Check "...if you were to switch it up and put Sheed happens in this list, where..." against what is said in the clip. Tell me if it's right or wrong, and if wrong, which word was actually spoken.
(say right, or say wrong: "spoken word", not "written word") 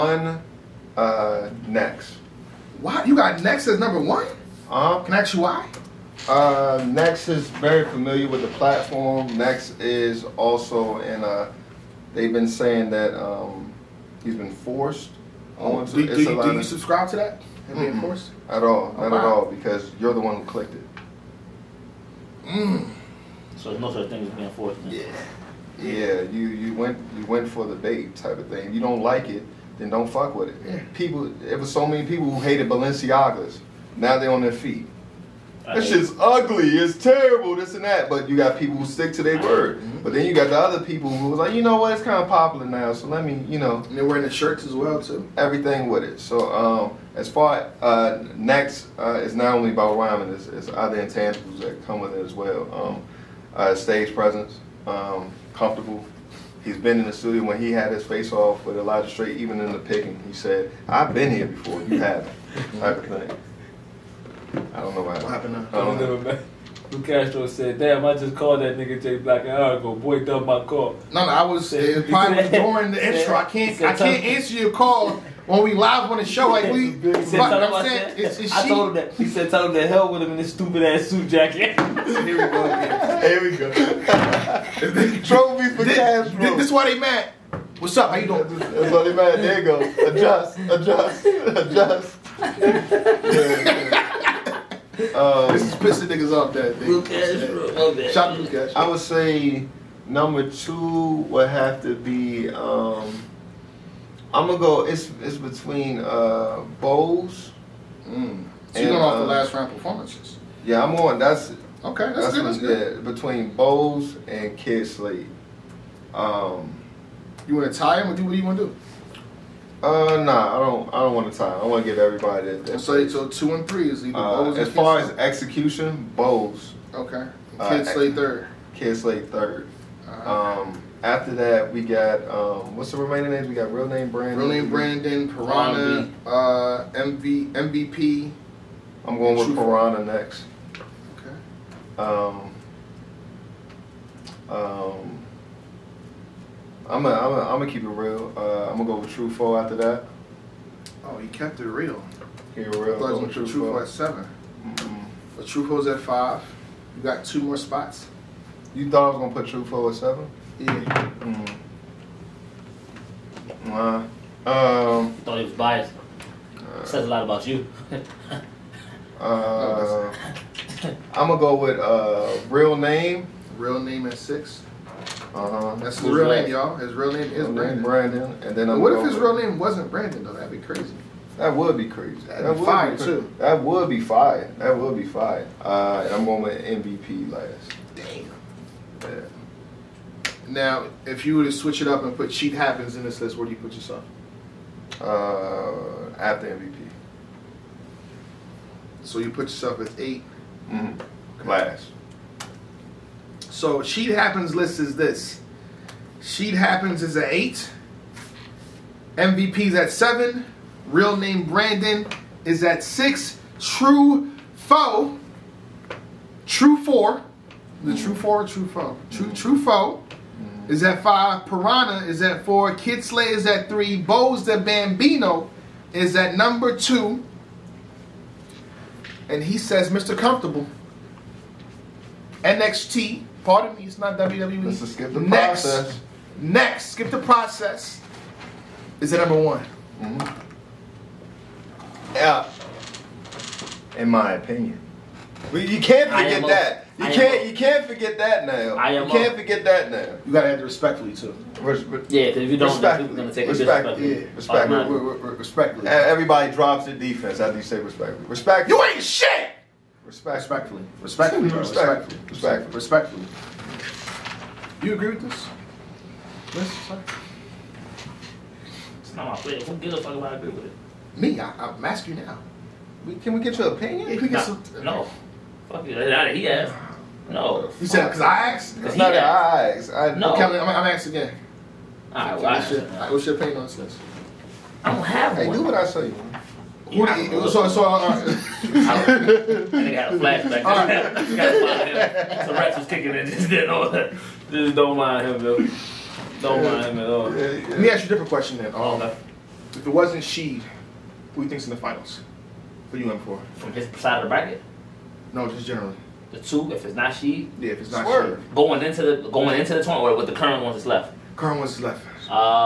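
right.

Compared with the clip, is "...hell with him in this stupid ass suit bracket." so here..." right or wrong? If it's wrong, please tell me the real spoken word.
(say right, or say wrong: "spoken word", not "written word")
wrong: "jacket", not "bracket".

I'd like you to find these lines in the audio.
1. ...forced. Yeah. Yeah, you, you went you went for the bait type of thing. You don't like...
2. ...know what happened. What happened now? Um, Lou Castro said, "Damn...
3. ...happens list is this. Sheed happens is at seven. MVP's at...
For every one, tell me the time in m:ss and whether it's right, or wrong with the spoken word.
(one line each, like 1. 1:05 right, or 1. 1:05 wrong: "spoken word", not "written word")
1. 0:24 right
2. 1:04 right
3. 3:24 wrong: "eight", not "seven".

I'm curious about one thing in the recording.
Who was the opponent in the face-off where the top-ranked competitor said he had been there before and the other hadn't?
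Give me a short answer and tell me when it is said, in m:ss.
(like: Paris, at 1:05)
Elijah Straight, at 0:58.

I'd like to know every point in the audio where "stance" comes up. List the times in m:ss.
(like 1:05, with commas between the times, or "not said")
not said.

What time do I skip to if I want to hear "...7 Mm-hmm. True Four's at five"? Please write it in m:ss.
2:33.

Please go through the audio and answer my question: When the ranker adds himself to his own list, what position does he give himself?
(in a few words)
8.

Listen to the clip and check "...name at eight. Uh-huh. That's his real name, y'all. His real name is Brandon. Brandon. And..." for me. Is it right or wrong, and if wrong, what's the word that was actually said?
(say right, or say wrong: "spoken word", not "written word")
wrong: "six", not "eight".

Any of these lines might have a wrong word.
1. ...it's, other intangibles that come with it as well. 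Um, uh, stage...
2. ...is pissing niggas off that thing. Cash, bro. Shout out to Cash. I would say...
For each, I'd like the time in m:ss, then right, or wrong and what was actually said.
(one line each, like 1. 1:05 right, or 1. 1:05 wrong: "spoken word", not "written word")
1. 0:50 right
2. 1:35 right.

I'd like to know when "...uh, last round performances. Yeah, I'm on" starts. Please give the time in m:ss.
1:49.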